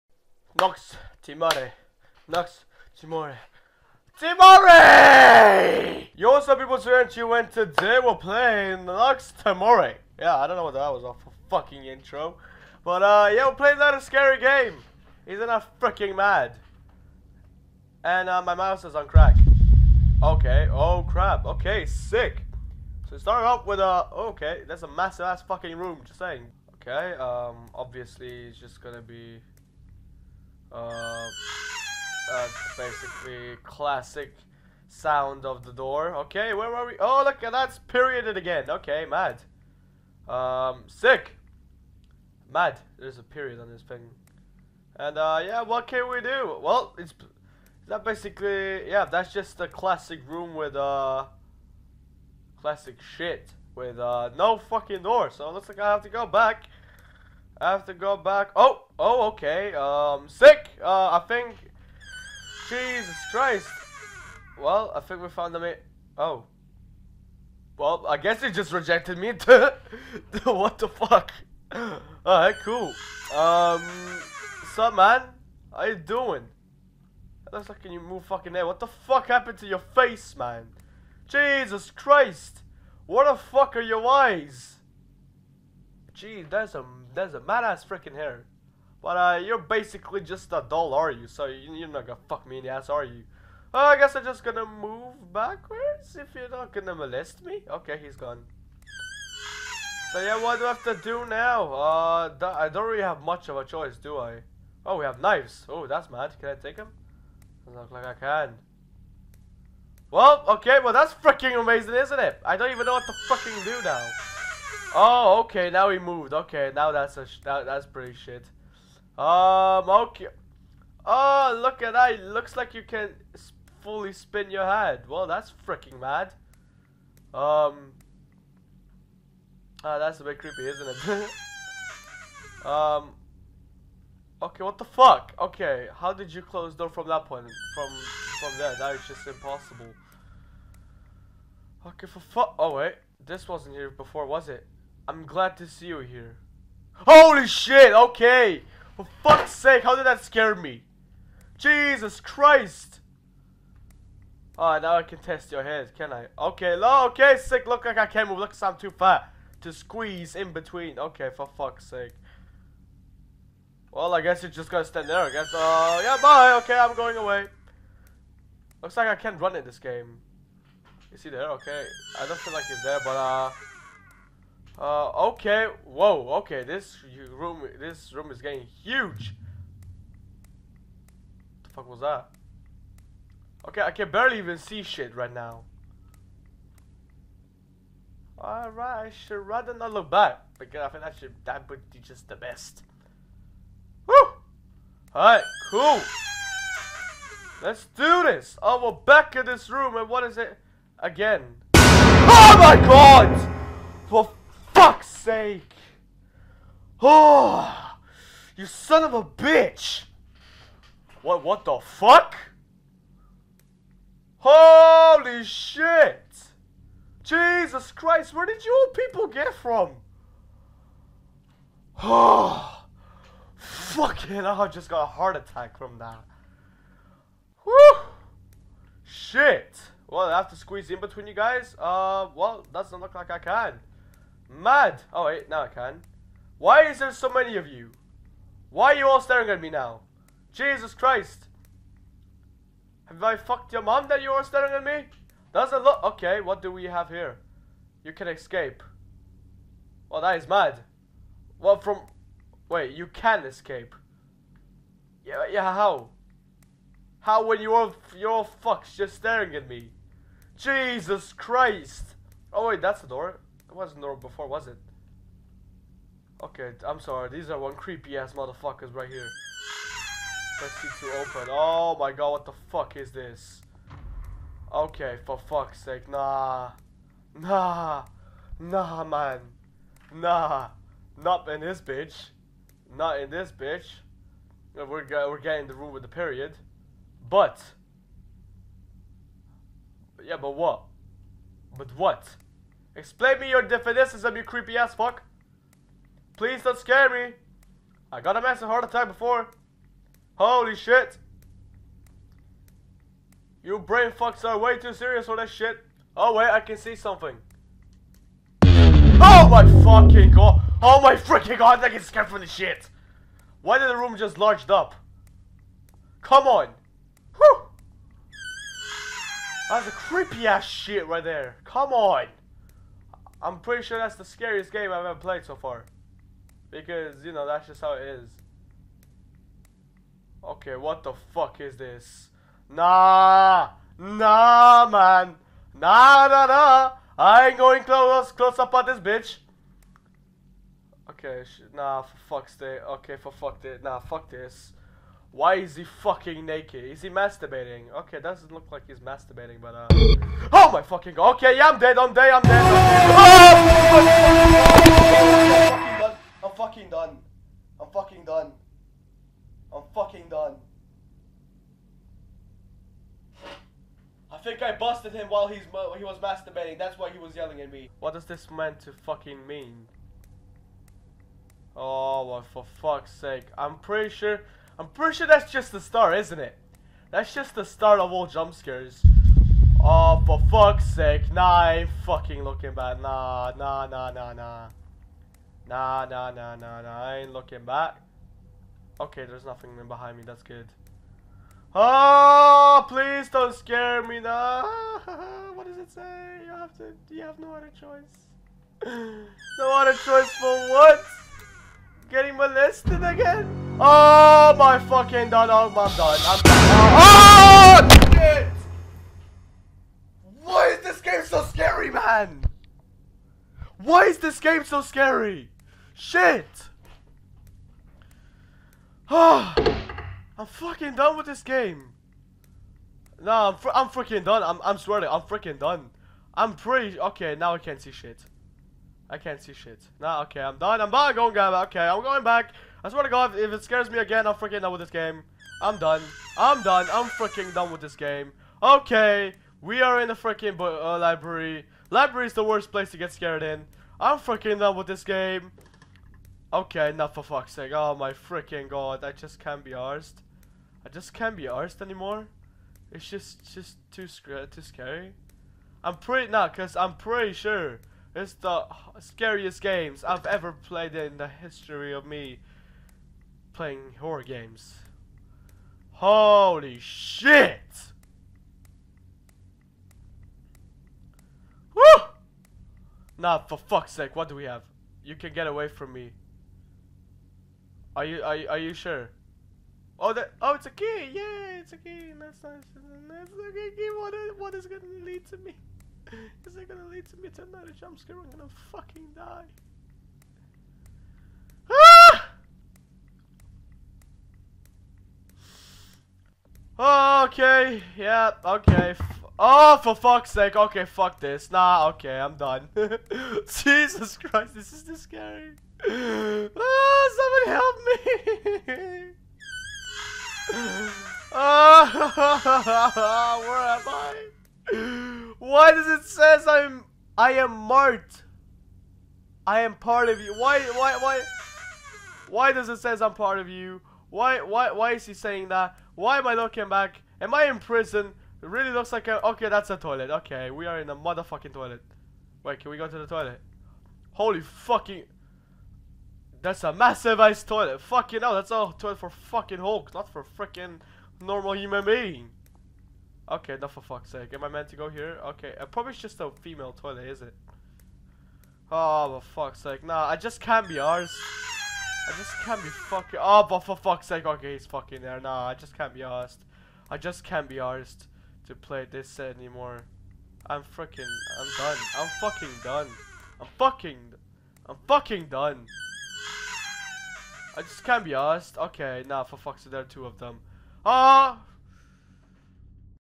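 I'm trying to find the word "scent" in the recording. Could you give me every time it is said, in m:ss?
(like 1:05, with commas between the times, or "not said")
not said.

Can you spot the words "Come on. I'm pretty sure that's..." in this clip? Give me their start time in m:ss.
5:21.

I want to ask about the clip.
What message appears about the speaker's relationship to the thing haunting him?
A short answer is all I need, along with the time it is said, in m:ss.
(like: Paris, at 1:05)
I am part of you, at 8:39.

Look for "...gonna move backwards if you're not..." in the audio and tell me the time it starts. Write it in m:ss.
1:34.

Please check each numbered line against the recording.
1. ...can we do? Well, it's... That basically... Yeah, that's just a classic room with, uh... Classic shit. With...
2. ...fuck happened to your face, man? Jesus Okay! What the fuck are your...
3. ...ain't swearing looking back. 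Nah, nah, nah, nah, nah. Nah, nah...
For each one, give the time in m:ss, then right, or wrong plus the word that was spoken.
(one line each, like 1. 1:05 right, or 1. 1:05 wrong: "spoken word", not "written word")
1. 0:45 right
2. 1:18 wrong: "Christ", not "Okay"
3. 6:21 wrong: "fucking", not "swearing".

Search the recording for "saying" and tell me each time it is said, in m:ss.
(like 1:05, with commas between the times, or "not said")
0:26, 8:45.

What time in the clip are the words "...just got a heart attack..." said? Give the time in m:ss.
3:44.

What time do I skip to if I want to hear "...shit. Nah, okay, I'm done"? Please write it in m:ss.
7:09.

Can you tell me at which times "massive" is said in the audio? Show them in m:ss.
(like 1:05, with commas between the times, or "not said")
0:24, 4:58, 8:56.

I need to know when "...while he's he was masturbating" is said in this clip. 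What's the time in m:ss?
6:05.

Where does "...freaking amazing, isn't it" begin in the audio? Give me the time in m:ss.
1:51.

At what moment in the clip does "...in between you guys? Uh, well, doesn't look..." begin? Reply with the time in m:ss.
3:50.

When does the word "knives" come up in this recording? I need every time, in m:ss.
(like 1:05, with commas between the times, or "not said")
1:45.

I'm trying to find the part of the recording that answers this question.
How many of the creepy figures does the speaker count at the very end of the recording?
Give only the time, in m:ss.
9:29.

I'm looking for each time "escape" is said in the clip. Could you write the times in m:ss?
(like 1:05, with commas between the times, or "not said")
4:08, 4:13.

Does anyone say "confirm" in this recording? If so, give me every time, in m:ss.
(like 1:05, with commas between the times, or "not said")
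not said.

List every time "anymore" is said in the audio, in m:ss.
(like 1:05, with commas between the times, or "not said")
7:31, 9:19.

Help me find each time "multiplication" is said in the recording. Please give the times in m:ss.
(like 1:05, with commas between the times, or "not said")
not said.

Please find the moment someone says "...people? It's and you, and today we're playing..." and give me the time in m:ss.
0:06.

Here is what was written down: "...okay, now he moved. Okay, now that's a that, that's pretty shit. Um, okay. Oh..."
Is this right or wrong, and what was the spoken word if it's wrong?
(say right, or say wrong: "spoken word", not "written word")
right.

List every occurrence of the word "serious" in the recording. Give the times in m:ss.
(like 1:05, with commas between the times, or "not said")
5:04.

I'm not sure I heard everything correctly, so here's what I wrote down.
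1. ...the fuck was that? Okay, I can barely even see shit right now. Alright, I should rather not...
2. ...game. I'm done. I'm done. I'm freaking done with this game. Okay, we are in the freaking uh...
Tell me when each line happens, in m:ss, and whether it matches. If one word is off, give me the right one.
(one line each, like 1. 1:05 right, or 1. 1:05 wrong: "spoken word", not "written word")
1. 3:01 right
2. 7:14 right.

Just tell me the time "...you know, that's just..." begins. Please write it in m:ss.
5:27.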